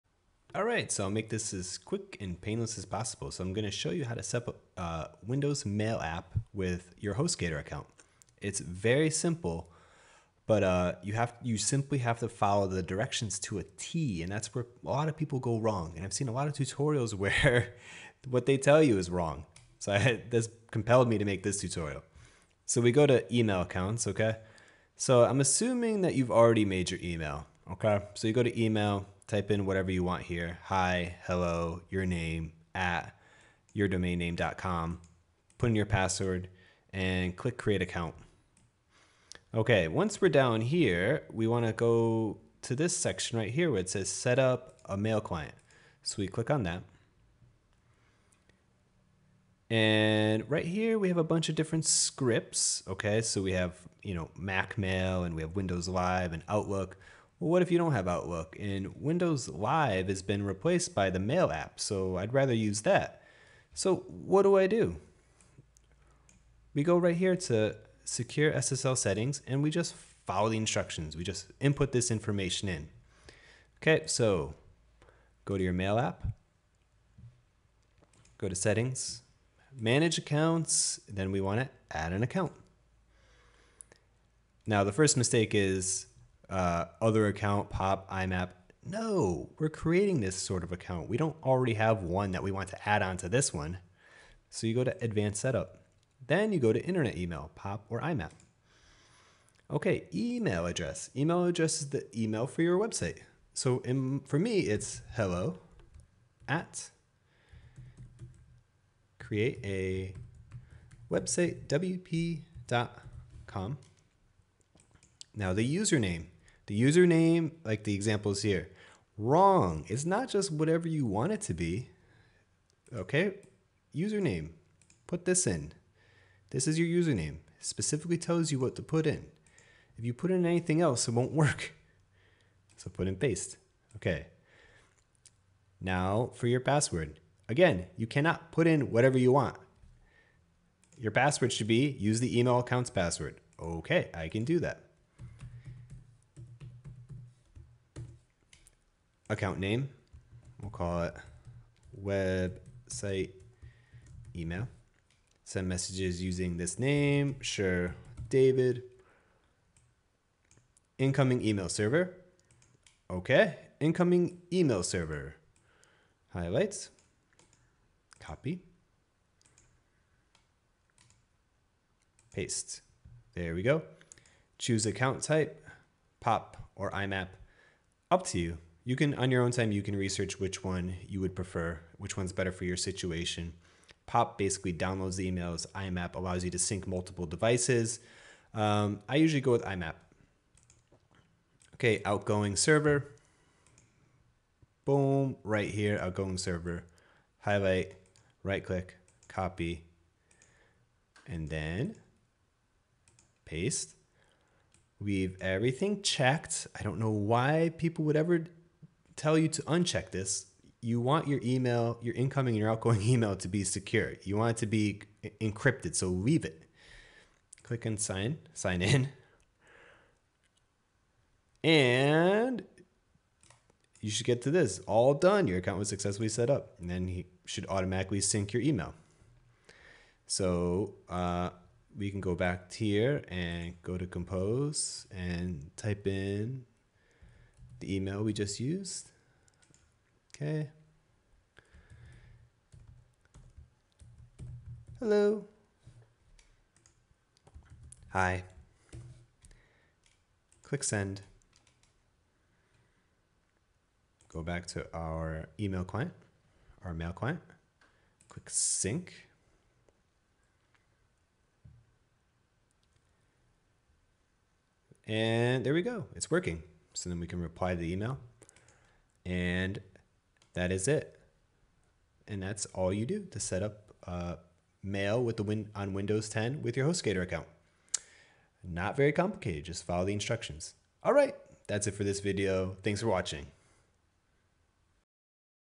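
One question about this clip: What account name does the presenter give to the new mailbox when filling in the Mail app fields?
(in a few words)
Website email.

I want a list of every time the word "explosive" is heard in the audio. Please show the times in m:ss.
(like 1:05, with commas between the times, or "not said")
not said.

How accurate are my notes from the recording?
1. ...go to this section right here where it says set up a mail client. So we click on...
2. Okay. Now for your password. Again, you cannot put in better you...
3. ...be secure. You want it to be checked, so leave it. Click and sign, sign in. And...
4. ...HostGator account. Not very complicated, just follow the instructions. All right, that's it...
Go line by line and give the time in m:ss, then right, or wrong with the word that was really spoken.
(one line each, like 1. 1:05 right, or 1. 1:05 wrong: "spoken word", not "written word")
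1. 0:41 right
2. 2:13 wrong: "whatever", not "better"
3. 3:33 wrong: "encrypted", not "checked"
4. 4:36 right.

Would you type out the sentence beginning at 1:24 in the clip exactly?
Now the first mistake is uh, other account, pop, IMAP.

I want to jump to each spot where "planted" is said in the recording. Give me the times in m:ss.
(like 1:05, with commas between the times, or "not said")
not said.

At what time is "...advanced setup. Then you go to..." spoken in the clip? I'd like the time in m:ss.
1:35.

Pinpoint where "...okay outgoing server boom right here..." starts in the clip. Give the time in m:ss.
3:11.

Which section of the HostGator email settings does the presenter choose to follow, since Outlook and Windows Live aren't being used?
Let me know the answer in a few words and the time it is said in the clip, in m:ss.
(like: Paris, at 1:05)
Secure SSL settings, at 1:08.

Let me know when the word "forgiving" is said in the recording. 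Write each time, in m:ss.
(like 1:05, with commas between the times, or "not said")
not said.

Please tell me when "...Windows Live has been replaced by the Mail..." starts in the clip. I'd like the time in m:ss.
0:59.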